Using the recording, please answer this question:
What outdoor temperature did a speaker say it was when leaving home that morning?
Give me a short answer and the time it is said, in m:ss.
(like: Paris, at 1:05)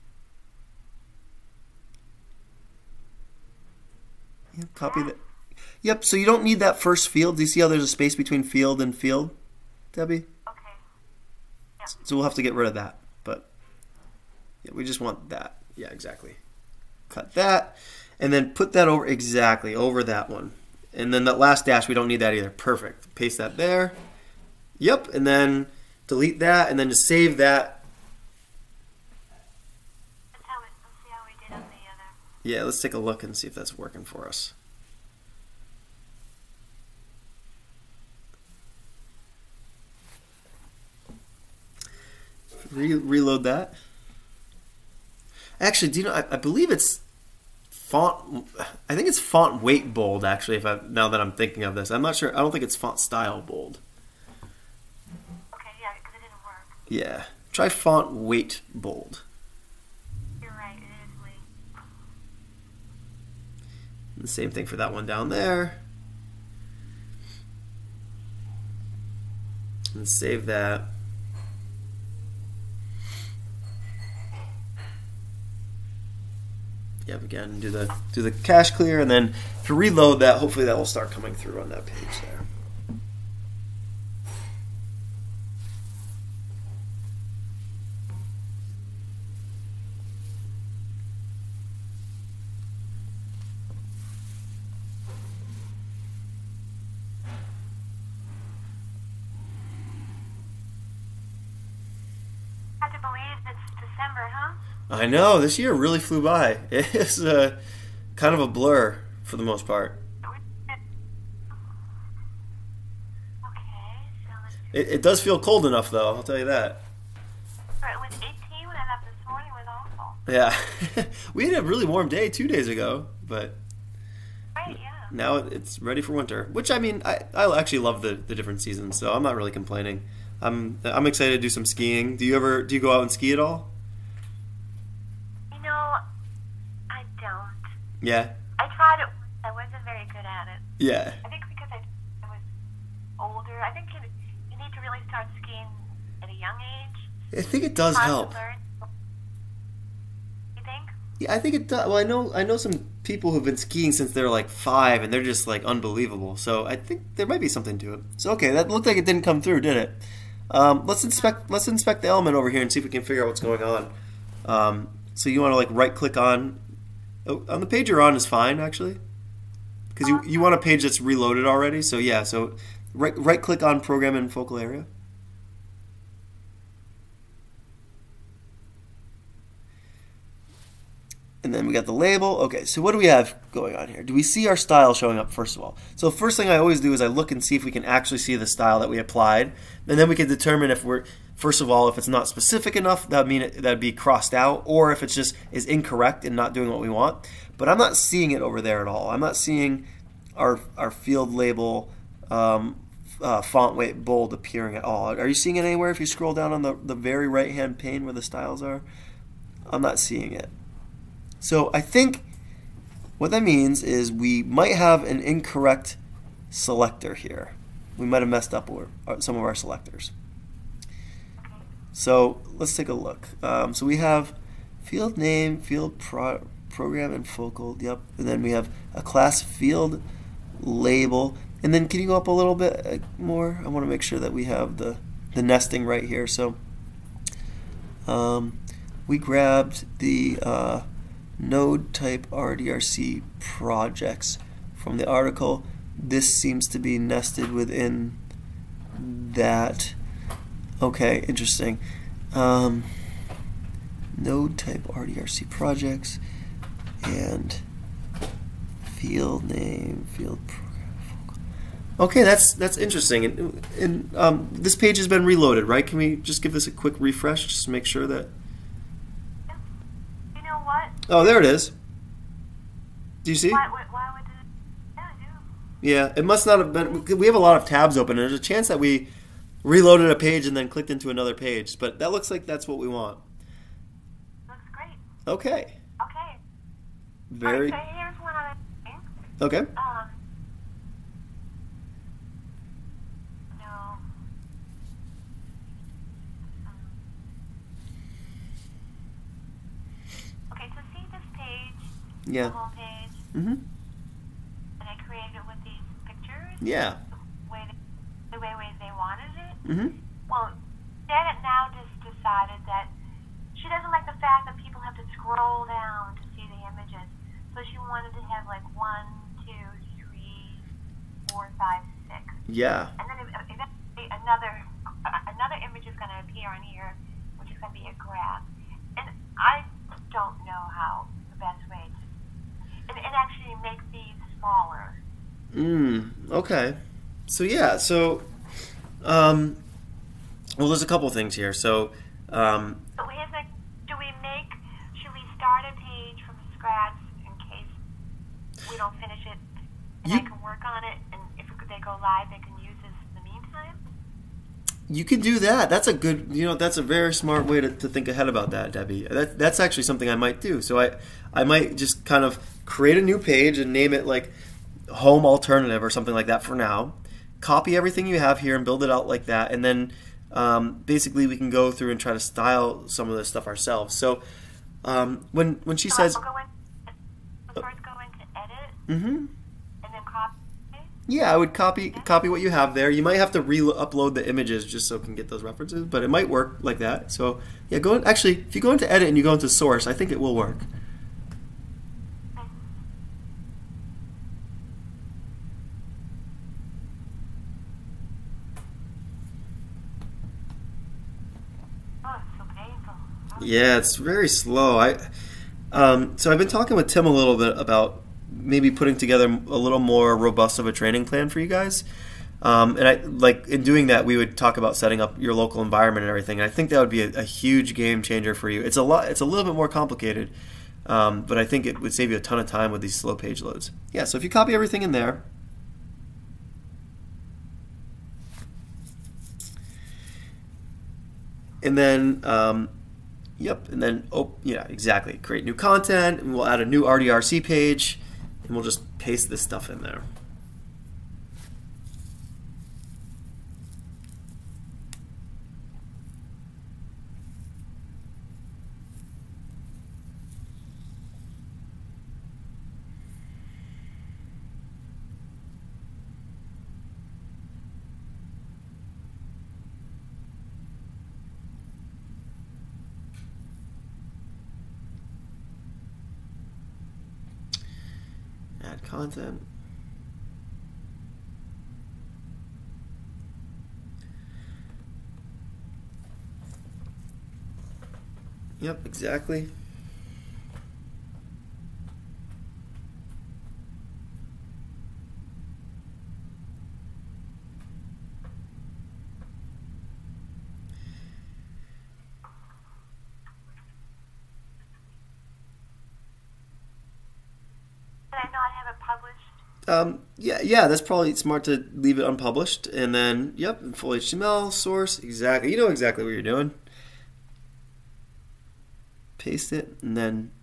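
18, at 1:58.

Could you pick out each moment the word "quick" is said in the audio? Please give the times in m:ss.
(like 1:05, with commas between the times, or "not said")
4:26.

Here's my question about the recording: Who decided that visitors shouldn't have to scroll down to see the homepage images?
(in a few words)
Janet.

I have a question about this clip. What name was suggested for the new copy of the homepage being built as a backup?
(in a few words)
home alternative.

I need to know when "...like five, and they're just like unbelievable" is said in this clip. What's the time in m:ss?
2:34.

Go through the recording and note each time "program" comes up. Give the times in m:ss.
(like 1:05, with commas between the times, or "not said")
2:53, 3:46, 4:20.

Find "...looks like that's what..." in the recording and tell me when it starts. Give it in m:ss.
4:42.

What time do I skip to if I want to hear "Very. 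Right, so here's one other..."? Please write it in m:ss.
4:47.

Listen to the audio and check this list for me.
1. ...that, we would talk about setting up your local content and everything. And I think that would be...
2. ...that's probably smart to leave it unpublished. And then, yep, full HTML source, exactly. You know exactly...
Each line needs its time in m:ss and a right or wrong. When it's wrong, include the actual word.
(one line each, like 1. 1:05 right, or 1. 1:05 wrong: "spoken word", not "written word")
1. 6:53 wrong: "environment", not "content"
2. 8:20 right.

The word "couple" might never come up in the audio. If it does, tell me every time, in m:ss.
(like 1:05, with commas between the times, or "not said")
5:40.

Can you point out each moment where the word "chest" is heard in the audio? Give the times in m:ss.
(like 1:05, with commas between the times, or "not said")
not said.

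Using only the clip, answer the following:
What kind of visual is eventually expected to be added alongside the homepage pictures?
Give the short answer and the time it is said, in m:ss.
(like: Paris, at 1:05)
a graph, at 5:27.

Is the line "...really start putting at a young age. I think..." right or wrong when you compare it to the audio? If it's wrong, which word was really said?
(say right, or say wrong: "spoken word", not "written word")
wrong: "skiing", not "putting".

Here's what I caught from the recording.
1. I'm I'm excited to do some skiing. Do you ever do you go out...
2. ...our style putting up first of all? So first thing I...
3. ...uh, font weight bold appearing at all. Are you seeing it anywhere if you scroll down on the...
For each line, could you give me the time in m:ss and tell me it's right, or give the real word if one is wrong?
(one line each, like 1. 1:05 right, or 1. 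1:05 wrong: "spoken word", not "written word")
1. 2:10 right
2. 3:04 wrong: "showing", not "putting"
3. 3:23 right.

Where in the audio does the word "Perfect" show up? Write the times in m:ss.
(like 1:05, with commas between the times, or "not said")
0:22.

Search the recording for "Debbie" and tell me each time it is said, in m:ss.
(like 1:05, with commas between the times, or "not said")
0:09, 5:58.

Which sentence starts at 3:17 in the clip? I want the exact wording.
But I'm not seeing it over there at all.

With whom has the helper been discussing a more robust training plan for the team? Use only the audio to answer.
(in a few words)
Tim.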